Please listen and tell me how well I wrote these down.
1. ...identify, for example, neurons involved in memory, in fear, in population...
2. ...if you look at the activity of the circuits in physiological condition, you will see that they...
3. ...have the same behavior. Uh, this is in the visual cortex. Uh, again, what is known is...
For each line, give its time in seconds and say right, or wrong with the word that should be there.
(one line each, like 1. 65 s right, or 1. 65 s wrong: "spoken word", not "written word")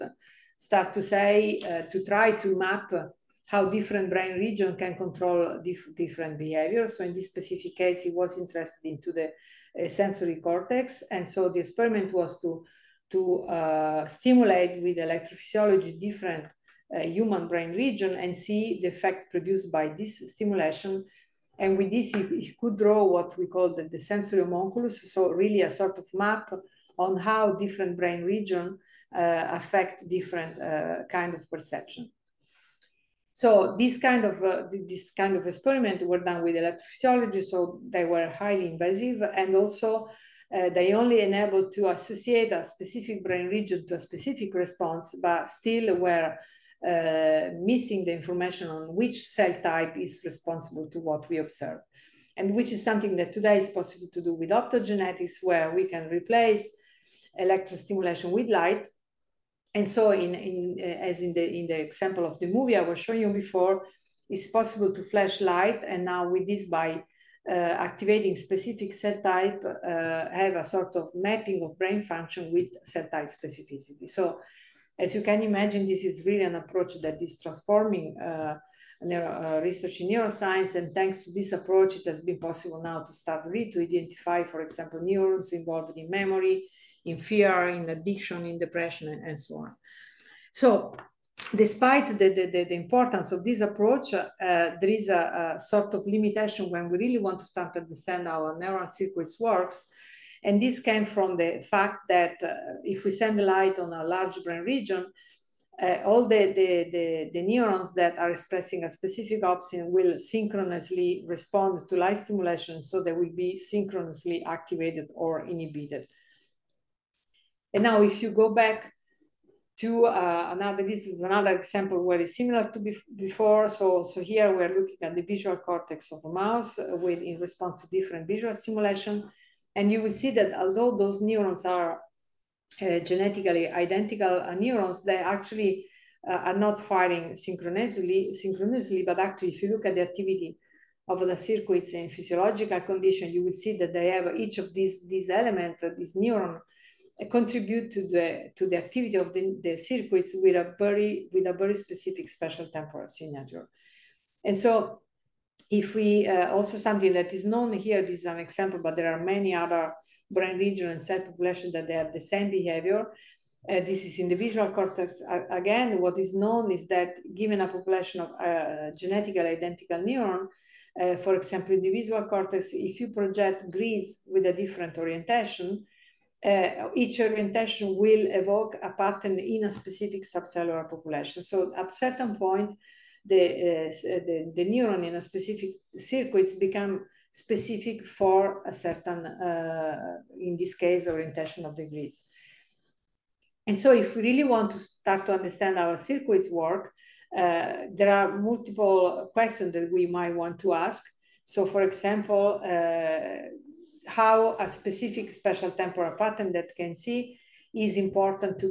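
1. 83 s wrong: "addiction", not "population"
2. 139 s right
3. 161 s right.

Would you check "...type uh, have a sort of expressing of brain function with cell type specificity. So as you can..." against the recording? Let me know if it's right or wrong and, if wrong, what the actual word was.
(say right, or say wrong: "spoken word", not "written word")
wrong: "mapping", not "expressing".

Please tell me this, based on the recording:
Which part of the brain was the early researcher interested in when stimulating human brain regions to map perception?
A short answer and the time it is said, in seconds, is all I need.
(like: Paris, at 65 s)
sensory cortex, at 9 s.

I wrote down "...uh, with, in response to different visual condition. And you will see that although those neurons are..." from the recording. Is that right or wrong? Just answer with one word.
wrong.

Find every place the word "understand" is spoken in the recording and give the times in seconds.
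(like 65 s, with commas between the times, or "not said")
97 s, 195 s.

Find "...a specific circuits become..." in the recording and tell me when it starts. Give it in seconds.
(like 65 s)
185 s.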